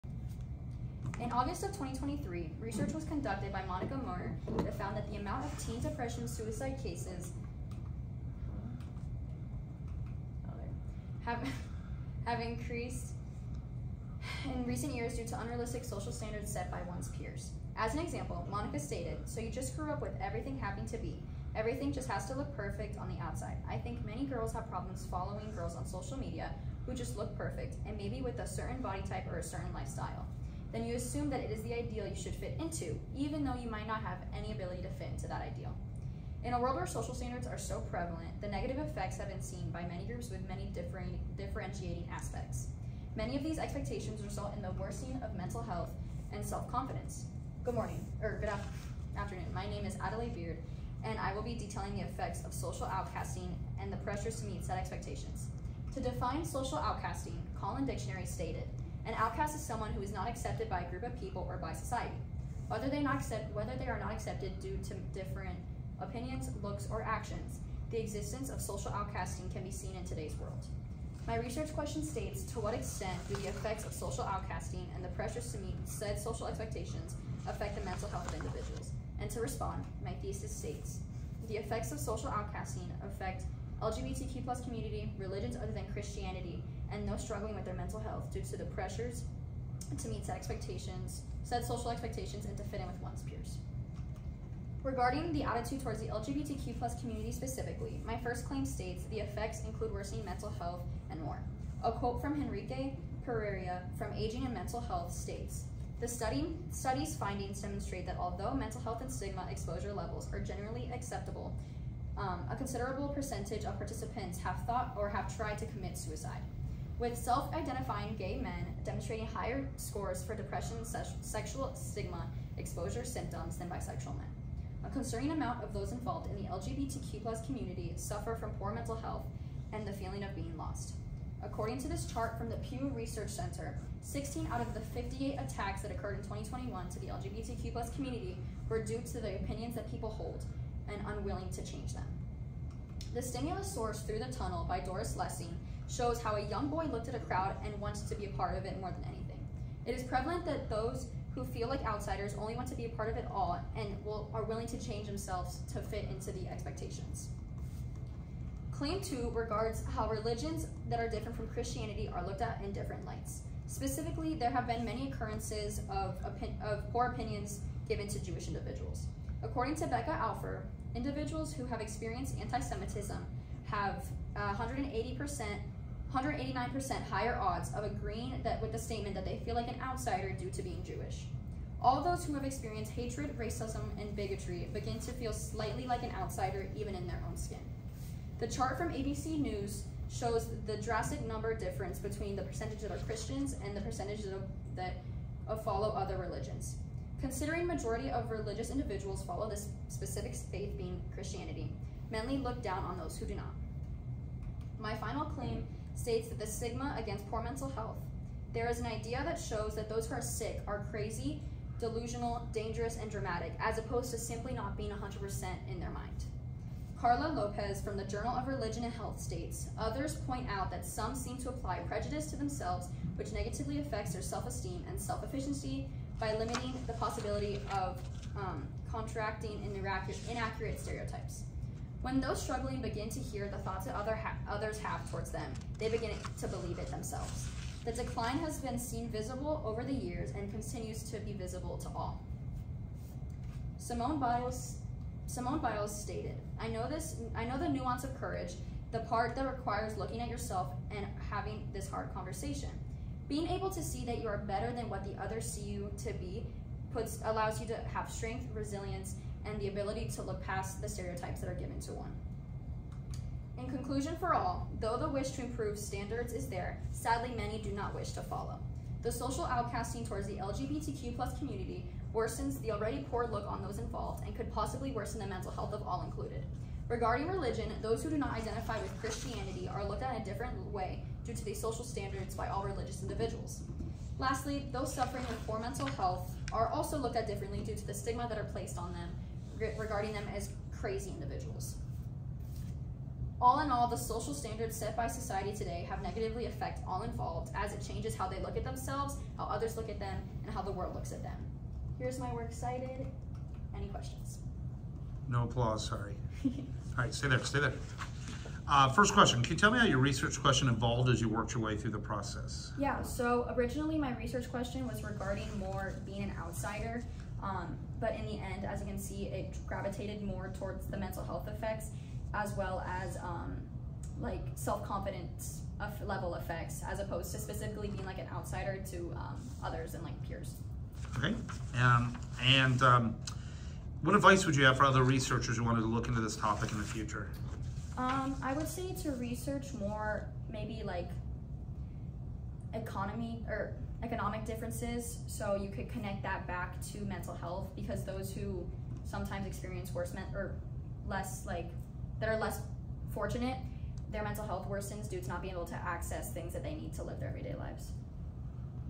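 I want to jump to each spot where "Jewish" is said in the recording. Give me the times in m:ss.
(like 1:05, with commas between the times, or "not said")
2:48, 3:00.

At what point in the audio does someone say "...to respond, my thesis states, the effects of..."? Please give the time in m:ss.
1:19.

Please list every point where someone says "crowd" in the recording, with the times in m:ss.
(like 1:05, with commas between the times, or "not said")
2:27.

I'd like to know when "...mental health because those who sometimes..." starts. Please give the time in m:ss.
5:47.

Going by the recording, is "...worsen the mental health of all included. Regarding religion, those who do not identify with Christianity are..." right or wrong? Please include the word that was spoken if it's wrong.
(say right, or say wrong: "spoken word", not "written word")
right.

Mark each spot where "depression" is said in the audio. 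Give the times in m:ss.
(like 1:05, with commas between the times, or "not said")
0:05, 2:00.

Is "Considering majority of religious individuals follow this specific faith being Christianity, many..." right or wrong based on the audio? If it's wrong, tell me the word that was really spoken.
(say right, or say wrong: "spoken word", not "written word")
right.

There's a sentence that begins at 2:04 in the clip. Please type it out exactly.
A concerning amount of those involved in the LGBTQ plus community suffer from poor mental health and the feeling of being lost.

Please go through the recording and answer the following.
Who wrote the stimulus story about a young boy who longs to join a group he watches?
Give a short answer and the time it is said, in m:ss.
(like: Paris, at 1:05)
Doris Lessing, at 2:24.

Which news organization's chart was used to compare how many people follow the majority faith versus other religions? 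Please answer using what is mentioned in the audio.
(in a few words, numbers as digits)
ABC News.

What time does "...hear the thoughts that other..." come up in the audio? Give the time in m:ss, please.
3:53.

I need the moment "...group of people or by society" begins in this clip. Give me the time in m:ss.
1:00.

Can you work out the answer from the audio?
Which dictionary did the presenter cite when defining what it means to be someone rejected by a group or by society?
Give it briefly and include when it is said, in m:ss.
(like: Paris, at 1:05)
Collin Dictionary, at 0:57.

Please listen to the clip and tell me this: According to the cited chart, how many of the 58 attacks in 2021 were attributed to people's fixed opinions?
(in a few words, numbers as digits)
16.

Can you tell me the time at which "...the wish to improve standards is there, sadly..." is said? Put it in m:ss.
4:24.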